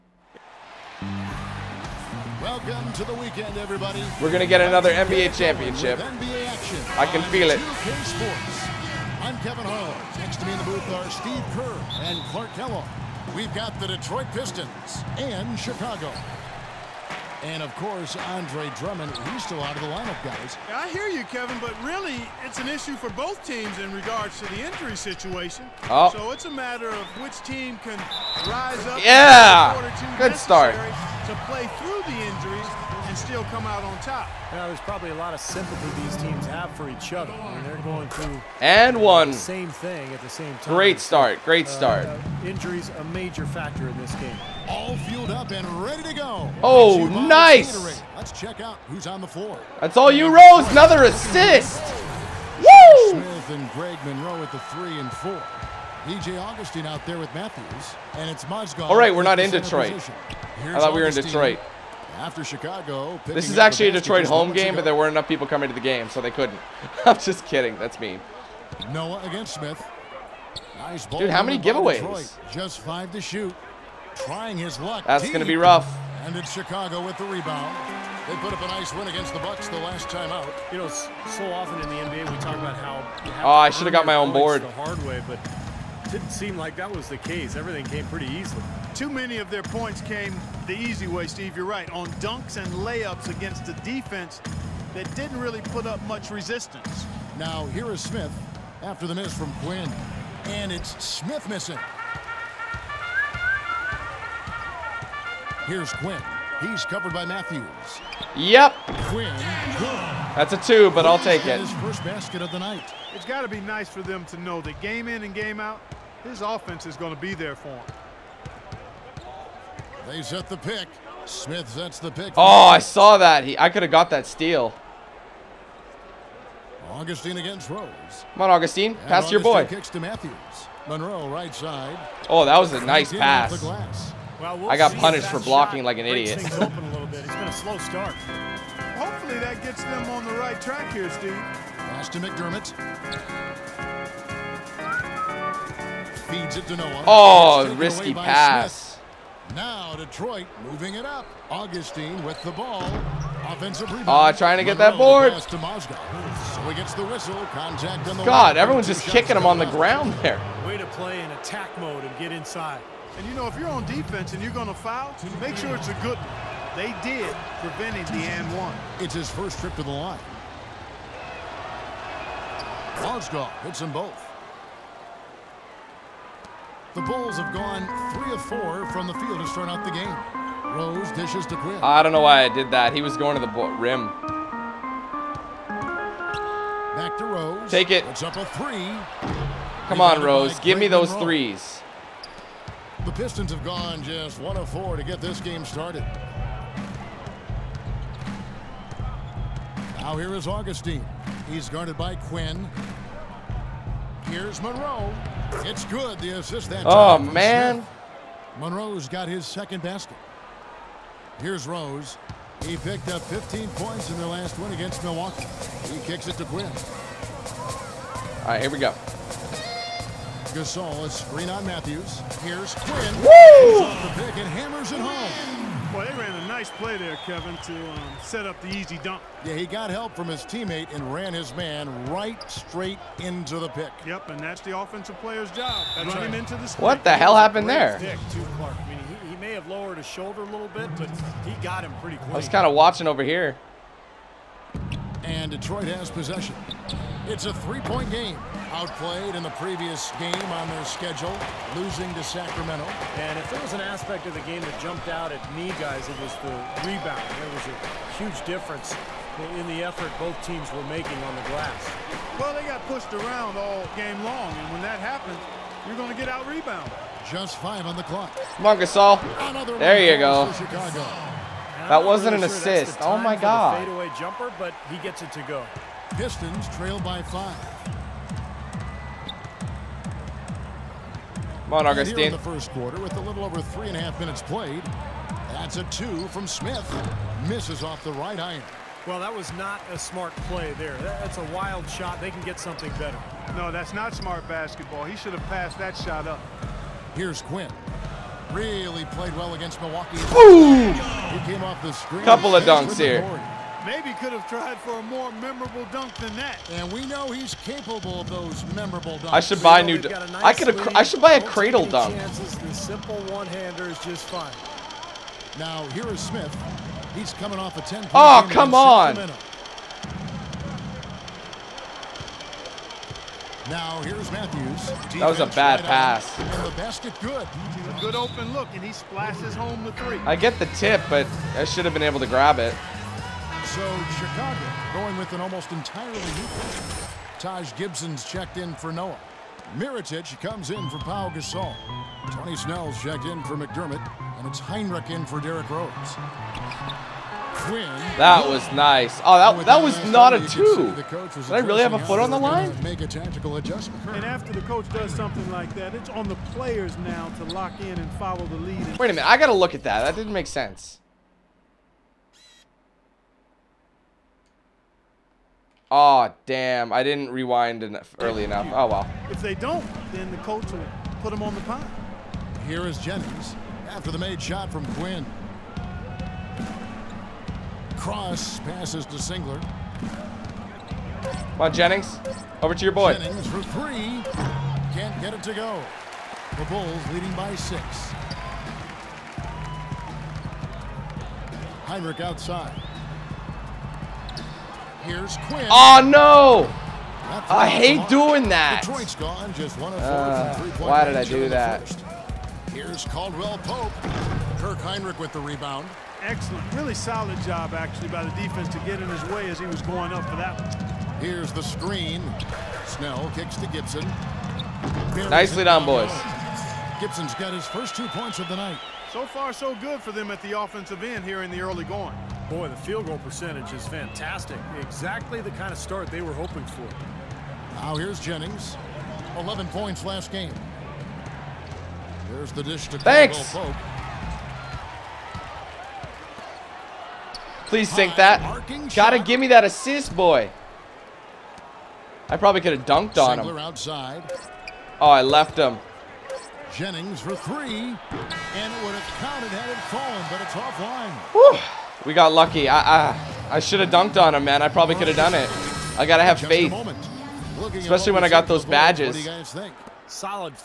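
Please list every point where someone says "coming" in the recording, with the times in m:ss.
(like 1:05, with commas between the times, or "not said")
1:05, 5:17.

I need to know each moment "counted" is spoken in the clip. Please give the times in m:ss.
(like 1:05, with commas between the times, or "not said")
7:29.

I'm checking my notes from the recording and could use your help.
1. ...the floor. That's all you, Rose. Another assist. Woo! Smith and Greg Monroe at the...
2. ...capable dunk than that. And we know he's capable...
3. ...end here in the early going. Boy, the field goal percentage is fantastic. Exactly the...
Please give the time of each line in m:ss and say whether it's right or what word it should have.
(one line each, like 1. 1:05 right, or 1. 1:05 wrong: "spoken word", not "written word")
1. 0:49 right
2. 5:05 wrong: "memorable", not "capable"
3. 7:01 right.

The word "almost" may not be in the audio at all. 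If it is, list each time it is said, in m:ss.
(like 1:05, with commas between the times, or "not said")
5:35.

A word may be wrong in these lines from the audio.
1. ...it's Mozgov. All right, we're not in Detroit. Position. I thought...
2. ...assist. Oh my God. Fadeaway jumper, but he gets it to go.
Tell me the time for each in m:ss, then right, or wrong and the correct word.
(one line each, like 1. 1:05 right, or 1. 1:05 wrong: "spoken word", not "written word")
1. 0:58 right
2. 4:32 right.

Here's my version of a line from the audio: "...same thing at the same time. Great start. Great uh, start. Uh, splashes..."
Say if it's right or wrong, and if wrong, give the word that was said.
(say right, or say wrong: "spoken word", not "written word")
wrong: "injuries", not "splashes".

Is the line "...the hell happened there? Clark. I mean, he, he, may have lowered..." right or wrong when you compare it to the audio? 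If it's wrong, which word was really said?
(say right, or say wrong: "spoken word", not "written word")
right.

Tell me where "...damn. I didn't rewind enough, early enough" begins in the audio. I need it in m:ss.
6:06.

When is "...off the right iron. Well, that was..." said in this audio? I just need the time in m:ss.
4:47.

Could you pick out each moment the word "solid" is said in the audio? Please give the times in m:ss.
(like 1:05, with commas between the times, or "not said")
6:46, 7:40.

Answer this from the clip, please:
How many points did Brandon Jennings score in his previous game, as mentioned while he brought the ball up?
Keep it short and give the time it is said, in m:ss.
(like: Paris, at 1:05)
11, at 7:09.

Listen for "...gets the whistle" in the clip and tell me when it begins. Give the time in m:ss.
2:36.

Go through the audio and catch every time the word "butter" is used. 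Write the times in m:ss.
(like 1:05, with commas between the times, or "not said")
not said.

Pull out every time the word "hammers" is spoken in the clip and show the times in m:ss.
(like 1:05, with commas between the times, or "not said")
3:44.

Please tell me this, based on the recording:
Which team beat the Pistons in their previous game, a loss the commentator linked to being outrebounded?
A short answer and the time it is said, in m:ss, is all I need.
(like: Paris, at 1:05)
Sacramento, at 4:12.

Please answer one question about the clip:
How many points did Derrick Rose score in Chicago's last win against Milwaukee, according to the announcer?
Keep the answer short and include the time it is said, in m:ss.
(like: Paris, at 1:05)
15, at 3:33.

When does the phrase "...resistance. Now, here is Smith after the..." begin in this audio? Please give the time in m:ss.
1:36.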